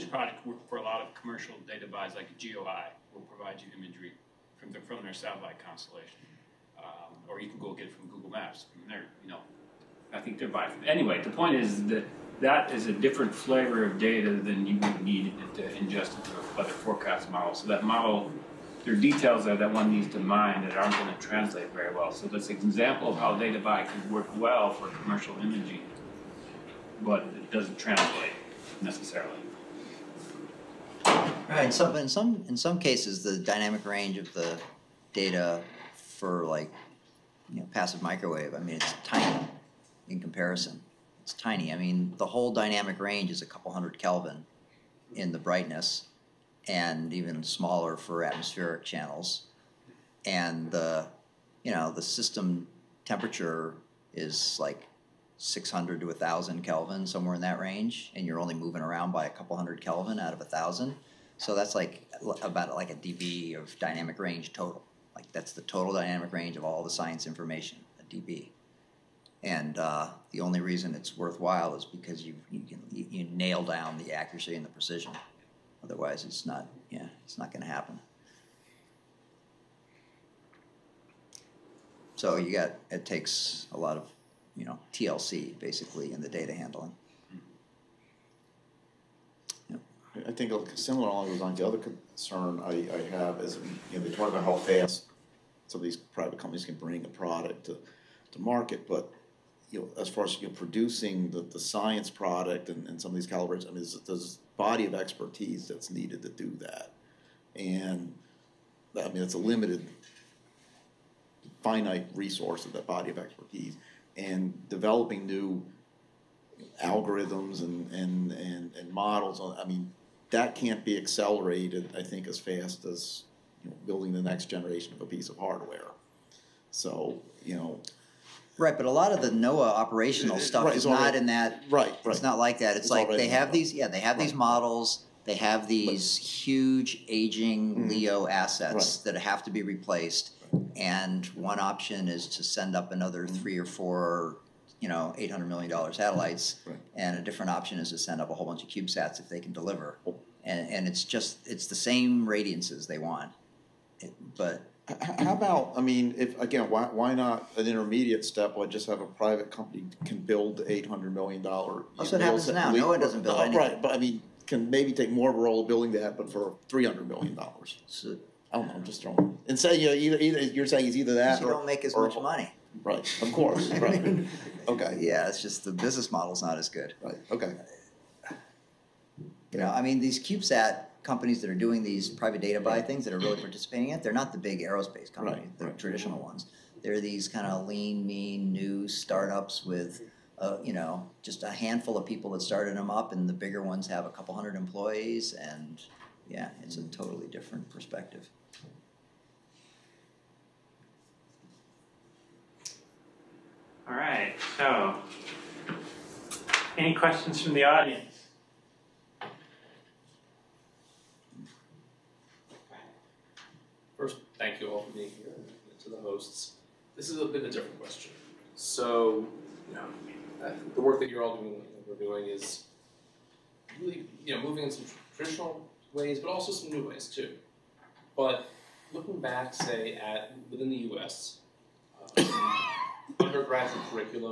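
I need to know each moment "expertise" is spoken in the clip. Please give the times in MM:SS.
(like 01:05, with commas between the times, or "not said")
01:44, 01:53.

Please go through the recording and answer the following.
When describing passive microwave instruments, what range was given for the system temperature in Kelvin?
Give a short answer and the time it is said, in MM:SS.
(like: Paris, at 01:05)
600 to 1,000 Kelvin, at 00:55.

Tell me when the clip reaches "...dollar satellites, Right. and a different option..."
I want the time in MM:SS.
02:25.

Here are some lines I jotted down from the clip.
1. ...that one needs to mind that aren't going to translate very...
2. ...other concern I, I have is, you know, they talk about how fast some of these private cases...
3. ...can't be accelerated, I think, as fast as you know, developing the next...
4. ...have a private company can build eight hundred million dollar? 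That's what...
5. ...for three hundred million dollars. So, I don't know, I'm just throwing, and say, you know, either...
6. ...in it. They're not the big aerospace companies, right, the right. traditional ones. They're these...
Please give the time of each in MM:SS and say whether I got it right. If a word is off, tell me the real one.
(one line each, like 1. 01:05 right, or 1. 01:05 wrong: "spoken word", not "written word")
1. 00:19 right
2. 01:31 wrong: "companies", not "cases"
3. 02:00 wrong: "building", not "developing"
4. 02:38 right
5. 02:46 right
6. 03:03 right.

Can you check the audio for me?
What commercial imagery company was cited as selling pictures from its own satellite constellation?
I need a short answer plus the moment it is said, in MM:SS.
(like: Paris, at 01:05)
GeoEye, at 00:02.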